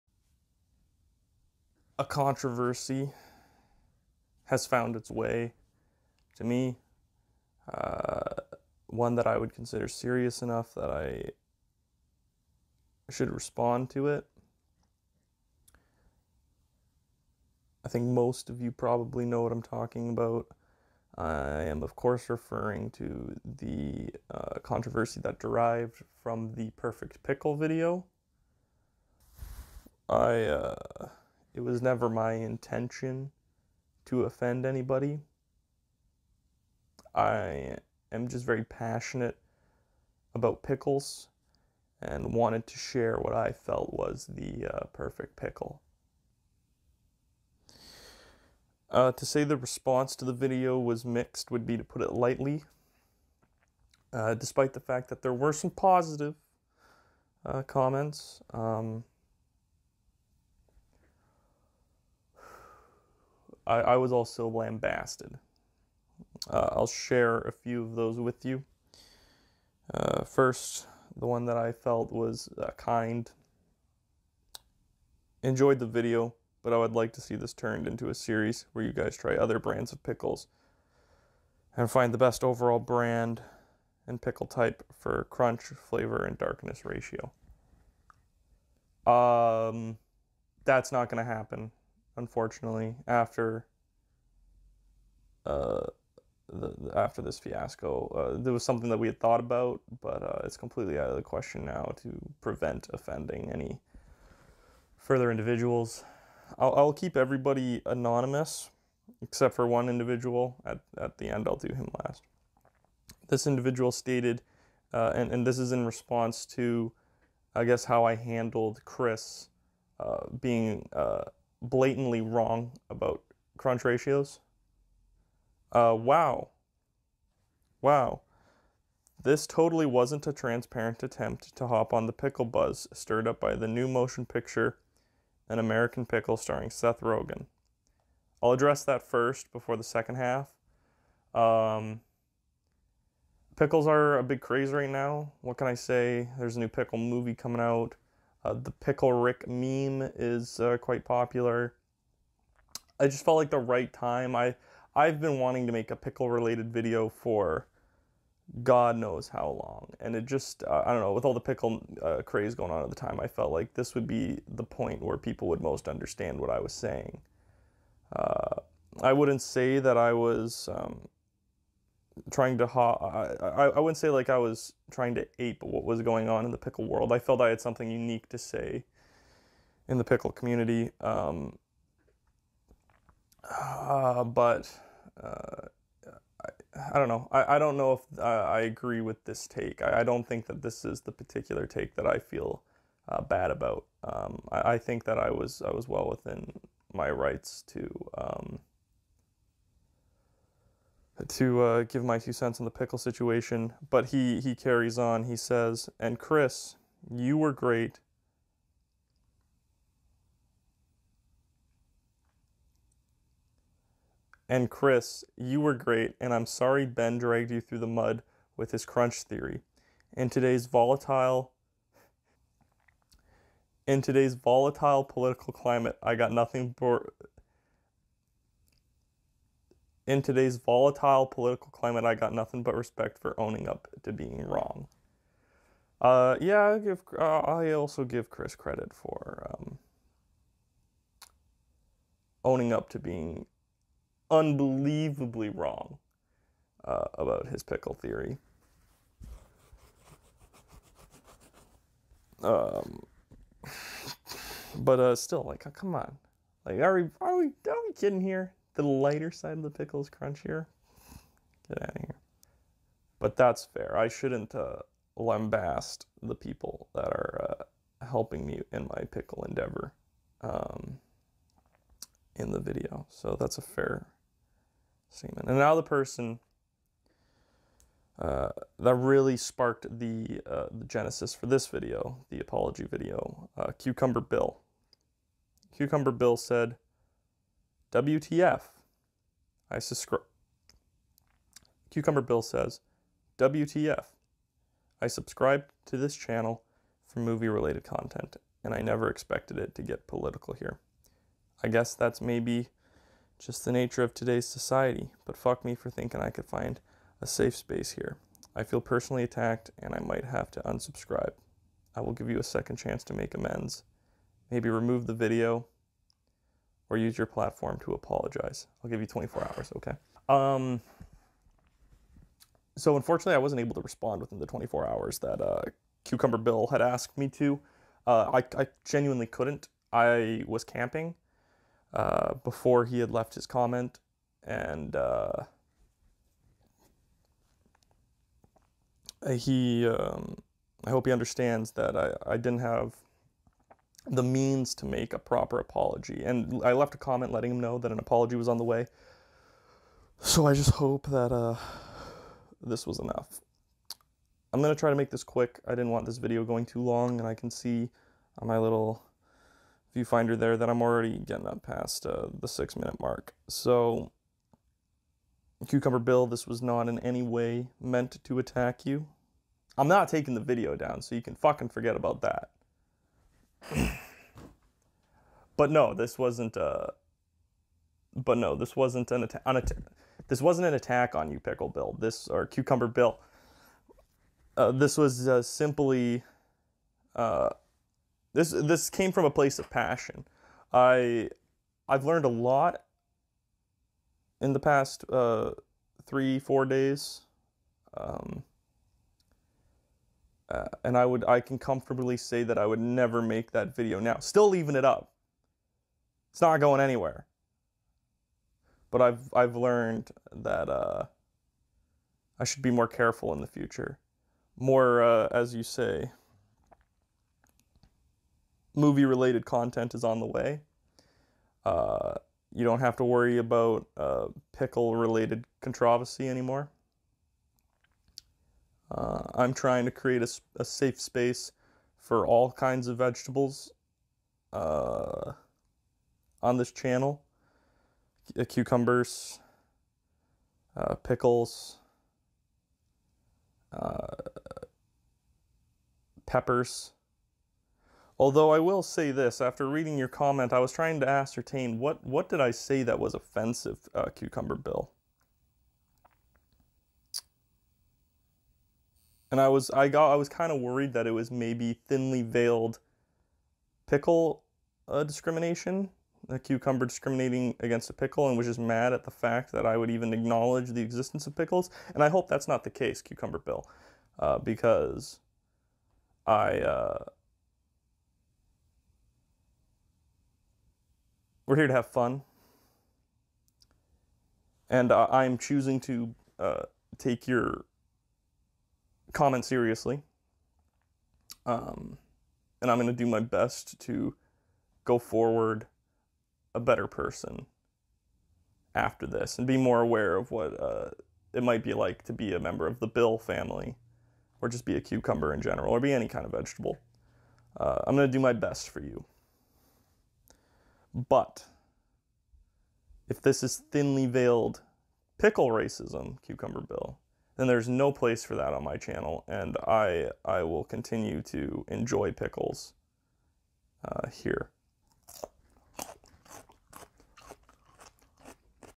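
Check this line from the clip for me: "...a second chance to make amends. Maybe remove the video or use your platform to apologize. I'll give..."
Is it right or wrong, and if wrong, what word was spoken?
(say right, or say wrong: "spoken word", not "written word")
right.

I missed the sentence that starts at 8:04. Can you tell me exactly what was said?
And uh, I'm choosing to uh, take your comment seriously.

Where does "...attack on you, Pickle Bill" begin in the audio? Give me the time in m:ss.
6:20.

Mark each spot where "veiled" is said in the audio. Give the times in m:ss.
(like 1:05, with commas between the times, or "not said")
7:42, 8:34.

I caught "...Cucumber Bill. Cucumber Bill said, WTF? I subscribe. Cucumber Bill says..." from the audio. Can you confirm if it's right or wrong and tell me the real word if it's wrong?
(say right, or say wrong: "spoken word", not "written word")
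right.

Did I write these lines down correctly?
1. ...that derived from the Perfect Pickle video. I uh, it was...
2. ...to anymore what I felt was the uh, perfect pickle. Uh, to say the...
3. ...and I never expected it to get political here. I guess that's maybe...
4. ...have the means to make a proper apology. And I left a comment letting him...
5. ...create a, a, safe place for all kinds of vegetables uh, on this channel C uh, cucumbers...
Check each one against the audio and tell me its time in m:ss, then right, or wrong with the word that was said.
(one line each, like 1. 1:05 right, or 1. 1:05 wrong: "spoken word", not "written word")
1. 0:25 right
2. 0:42 wrong: "share", not "anymore"
3. 4:58 right
4. 5:42 right
5. 7:09 wrong: "space", not "place".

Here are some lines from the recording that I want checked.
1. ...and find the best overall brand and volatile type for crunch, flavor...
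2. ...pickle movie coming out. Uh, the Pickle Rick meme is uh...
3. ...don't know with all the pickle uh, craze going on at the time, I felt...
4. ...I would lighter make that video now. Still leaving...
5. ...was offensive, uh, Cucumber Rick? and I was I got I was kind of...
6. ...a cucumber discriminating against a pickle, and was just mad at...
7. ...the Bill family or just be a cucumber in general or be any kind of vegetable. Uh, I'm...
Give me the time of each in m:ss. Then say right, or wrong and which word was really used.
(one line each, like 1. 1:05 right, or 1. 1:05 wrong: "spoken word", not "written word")
1. 1:21 wrong: "pickle", not "volatile"
2. 2:26 right
3. 2:40 right
4. 6:42 wrong: "never", not "lighter"
5. 7:32 wrong: "Bill", not "Rick"
6. 7:46 right
7. 8:22 right.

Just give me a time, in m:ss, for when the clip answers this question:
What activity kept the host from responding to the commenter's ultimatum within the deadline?
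5:30.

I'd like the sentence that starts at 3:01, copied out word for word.
Um, uh, but uh, I, I, don't know.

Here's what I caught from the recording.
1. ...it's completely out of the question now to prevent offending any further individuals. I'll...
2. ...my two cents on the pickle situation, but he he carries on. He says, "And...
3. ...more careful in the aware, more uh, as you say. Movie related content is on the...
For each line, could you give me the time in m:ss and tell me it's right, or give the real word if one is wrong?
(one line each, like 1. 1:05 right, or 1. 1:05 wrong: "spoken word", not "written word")
1. 1:40 right
2. 3:22 right
3. 6:52 wrong: "future", not "aware".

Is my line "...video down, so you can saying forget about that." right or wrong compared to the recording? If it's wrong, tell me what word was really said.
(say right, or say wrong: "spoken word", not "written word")
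wrong: "fucking", not "saying".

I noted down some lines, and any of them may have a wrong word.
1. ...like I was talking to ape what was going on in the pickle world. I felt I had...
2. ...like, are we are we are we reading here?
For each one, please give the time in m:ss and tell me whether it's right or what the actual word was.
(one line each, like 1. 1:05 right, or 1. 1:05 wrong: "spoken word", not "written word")
1. 2:54 wrong: "trying", not "talking"
2. 4:16 wrong: "kidding", not "reading".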